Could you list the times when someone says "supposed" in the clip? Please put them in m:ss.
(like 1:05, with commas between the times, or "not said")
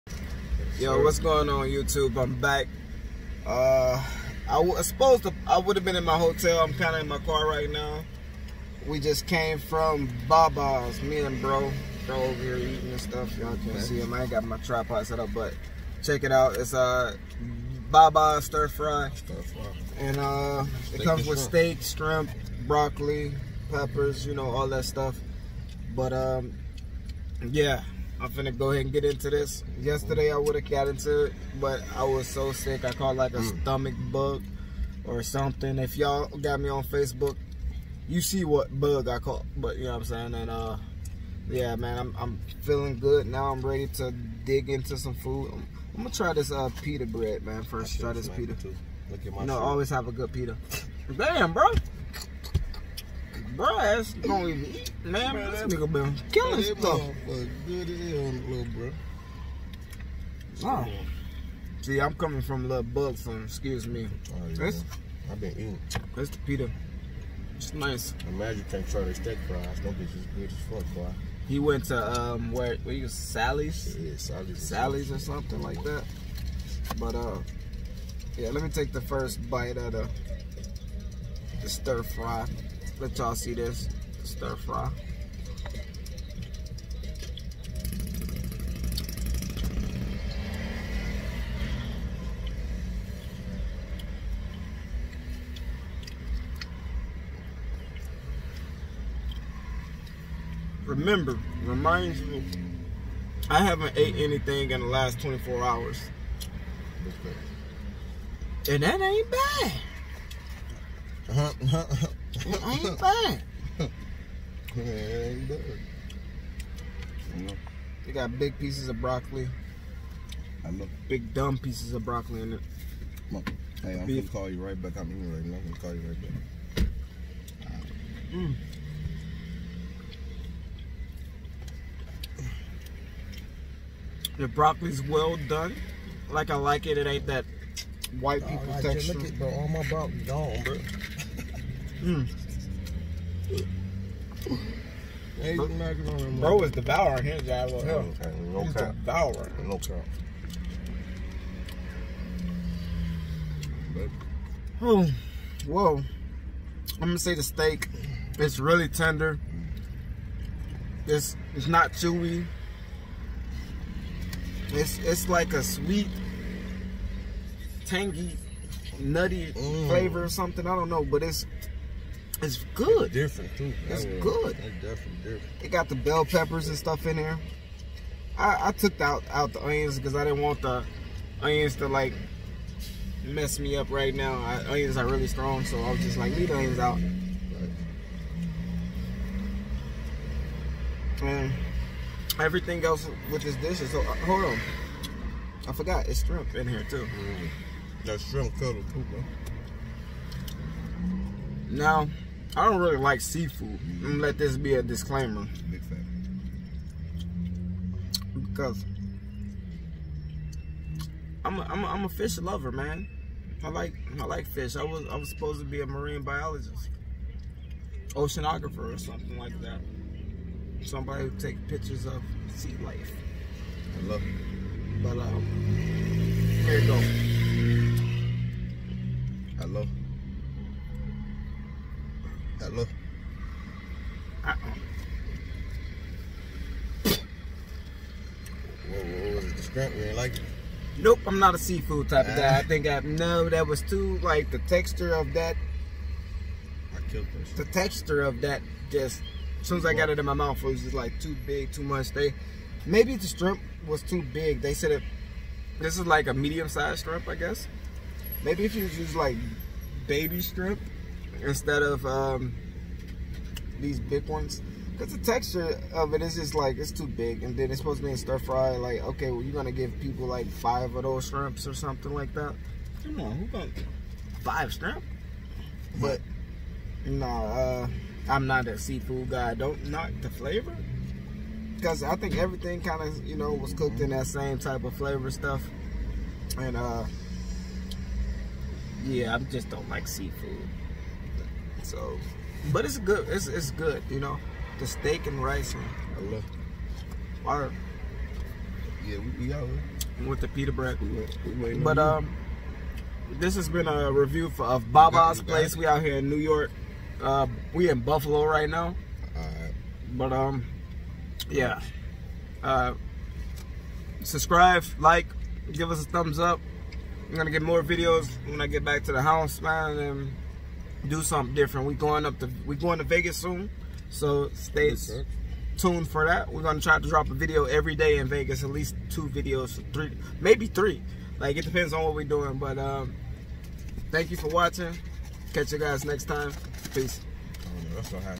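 0:04, 3:35, 4:27.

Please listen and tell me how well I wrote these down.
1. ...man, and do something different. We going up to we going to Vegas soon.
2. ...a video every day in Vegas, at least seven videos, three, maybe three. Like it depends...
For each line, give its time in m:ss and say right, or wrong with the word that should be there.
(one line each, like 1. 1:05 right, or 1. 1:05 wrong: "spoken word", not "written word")
1. 5:19 right
2. 5:27 wrong: "two", not "seven".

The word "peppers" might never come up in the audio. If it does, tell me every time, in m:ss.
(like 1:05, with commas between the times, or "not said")
0:23, 2:56.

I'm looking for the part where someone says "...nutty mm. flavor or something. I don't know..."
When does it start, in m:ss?
2:48.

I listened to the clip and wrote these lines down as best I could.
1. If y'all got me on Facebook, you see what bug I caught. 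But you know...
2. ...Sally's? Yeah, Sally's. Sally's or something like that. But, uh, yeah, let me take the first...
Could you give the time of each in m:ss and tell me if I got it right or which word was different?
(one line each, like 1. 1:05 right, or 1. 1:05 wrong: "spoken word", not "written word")
1. 0:35 right
2. 1:13 right.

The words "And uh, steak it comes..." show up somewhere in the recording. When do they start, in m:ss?
0:19.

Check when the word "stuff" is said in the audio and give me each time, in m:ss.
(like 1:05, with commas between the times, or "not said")
0:12, 0:24, 0:56, 2:56, 4:45.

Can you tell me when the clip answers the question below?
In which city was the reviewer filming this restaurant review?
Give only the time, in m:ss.
5:08.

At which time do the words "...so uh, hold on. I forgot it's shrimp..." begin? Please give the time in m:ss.
3:13.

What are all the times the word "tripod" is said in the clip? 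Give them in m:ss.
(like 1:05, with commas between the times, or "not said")
0:14.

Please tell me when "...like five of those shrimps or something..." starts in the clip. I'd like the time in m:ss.
4:30.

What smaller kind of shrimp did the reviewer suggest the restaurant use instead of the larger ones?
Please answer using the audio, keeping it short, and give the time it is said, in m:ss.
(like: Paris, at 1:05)
Baby shrimp, at 4:20.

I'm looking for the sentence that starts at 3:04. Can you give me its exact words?
I, onions are really strong, so I was just like leave the onions out.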